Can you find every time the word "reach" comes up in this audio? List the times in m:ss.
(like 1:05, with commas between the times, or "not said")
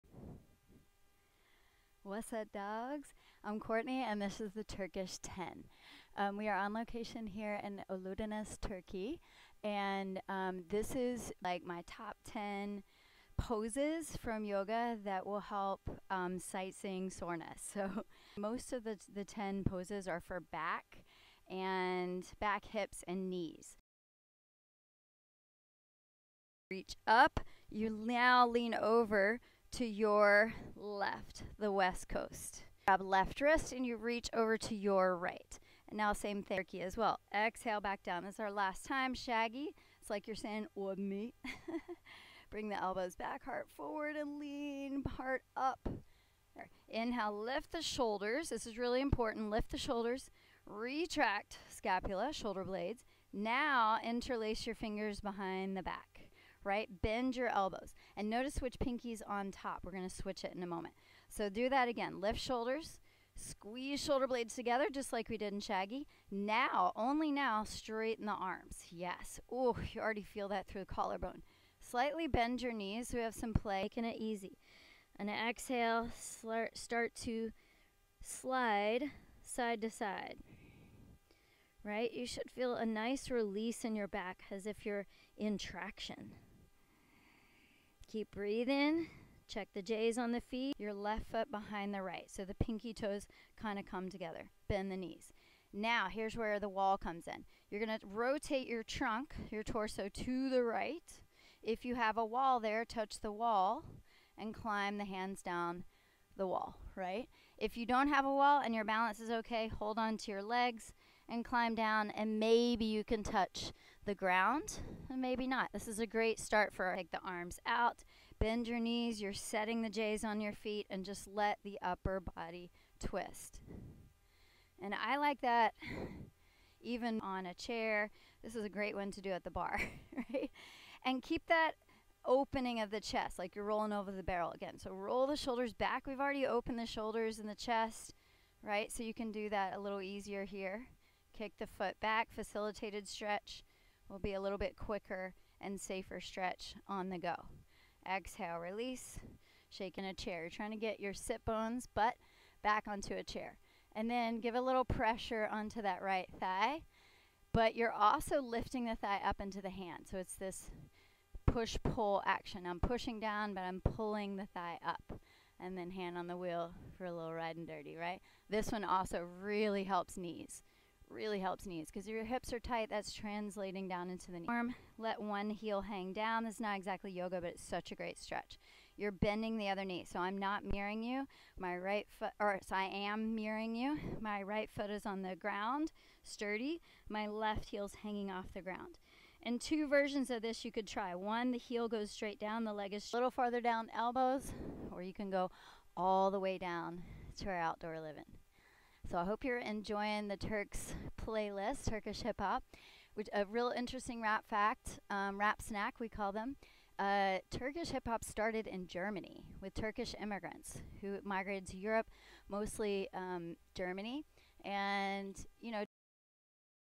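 0:26, 0:33.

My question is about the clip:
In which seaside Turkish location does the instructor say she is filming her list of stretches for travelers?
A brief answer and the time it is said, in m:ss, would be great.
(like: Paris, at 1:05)
Oludeniz, at 0:07.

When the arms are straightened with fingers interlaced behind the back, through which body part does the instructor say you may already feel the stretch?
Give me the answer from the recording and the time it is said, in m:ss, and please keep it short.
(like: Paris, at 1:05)
the collarbone, at 1:10.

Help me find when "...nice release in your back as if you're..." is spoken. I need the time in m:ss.
1:22.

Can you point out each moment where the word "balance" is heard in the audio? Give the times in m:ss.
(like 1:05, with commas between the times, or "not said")
1:48.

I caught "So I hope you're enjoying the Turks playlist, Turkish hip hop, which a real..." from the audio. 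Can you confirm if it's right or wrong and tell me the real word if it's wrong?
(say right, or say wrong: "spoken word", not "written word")
right.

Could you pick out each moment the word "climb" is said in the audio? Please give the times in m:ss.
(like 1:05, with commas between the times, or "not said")
1:44, 1:51.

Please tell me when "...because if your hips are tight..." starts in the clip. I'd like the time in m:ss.
2:51.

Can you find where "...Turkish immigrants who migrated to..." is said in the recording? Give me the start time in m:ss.
3:29.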